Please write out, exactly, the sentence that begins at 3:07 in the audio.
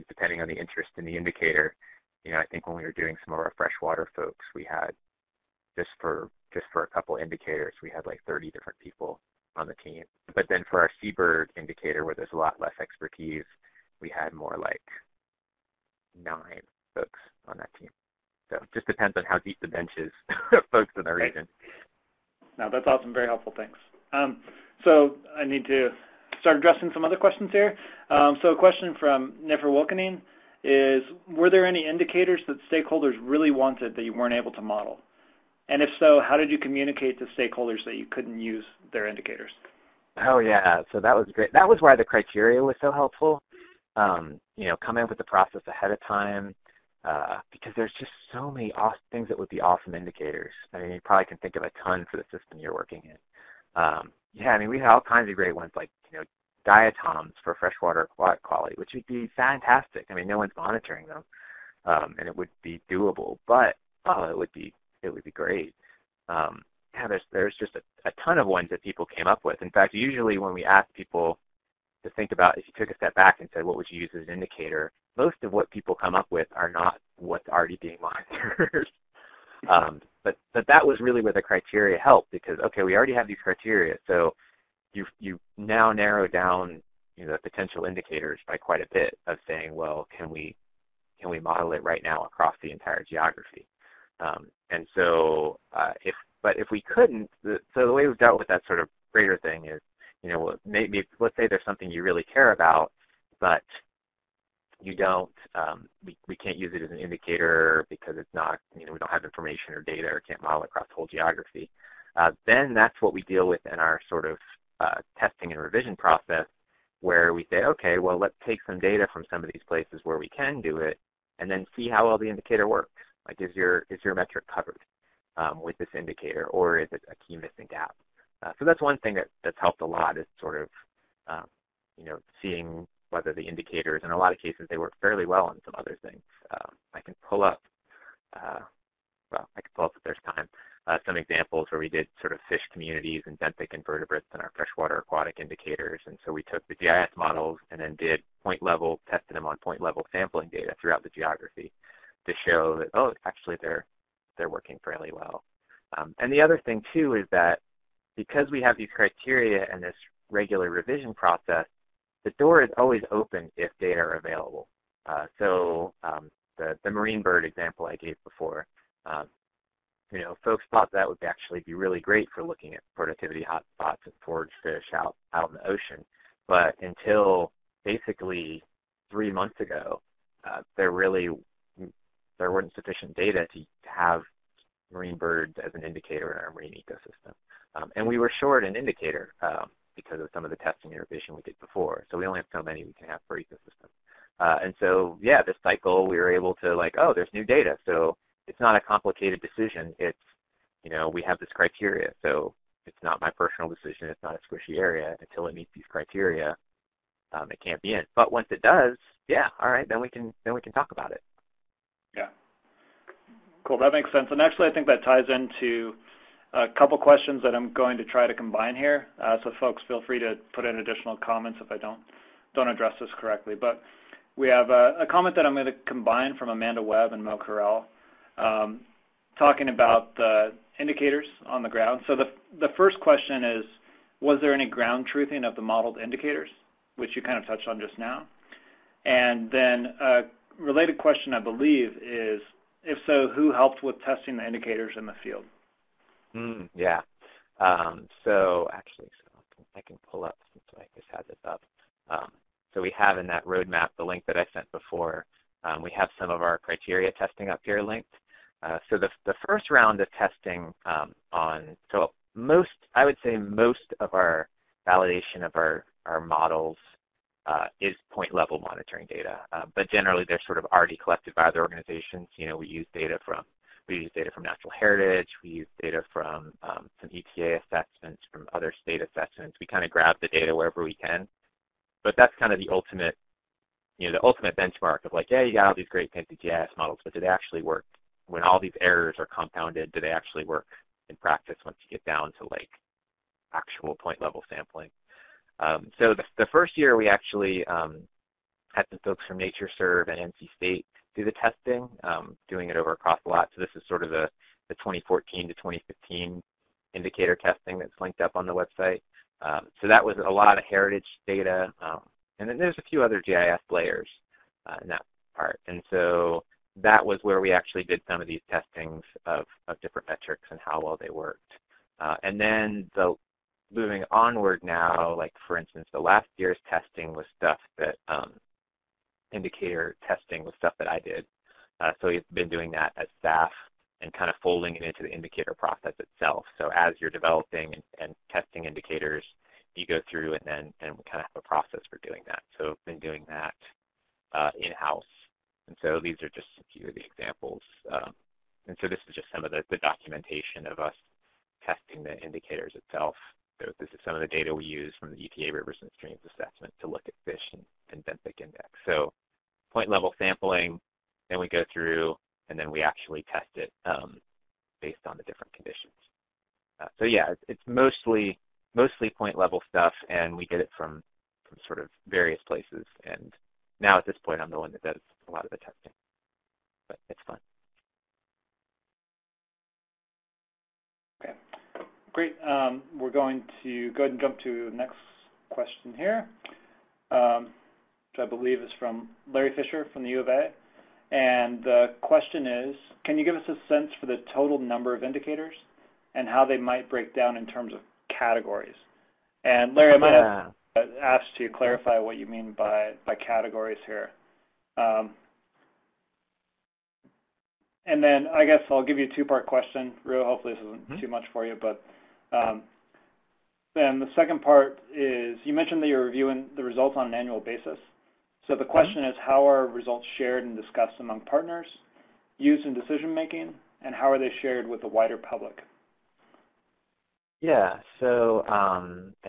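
Um, and we were short an indicator um, because of some of the testing revision we did before.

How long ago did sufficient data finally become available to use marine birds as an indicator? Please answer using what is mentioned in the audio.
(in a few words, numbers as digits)
3 months.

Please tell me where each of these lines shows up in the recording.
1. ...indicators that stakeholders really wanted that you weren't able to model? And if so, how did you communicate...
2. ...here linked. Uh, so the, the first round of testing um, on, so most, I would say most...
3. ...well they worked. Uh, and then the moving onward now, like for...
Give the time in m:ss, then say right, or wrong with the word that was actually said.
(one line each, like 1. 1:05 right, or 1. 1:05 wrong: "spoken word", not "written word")
1. 0:31 right
2. 4:17 right
3. 5:20 right.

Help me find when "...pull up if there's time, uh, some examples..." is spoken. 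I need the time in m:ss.
2:19.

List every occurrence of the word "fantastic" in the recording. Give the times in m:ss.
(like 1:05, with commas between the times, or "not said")
0:59.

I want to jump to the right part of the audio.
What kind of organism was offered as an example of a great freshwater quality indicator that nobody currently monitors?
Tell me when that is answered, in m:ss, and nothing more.
0:56.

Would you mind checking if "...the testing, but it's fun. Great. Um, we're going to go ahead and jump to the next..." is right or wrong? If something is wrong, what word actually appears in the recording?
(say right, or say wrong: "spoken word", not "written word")
right.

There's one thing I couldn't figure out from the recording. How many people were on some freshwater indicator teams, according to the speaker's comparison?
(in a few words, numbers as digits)
30.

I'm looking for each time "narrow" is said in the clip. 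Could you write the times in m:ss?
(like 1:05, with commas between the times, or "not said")
1:25.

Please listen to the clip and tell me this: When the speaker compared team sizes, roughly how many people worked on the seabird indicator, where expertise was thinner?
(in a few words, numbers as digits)
9.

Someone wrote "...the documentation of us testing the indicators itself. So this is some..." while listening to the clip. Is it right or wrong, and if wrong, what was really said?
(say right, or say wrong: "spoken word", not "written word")
right.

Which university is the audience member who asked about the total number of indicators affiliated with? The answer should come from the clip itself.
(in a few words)
U of A.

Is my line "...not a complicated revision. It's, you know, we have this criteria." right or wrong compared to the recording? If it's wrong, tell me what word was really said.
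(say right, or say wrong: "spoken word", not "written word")
wrong: "decision", not "revision".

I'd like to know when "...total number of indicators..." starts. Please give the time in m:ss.
6:34.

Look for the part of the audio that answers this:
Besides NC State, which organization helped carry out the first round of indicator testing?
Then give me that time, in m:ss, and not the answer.
4:59.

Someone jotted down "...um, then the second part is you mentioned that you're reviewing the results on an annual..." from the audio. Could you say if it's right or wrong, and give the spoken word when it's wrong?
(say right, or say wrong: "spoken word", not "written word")
right.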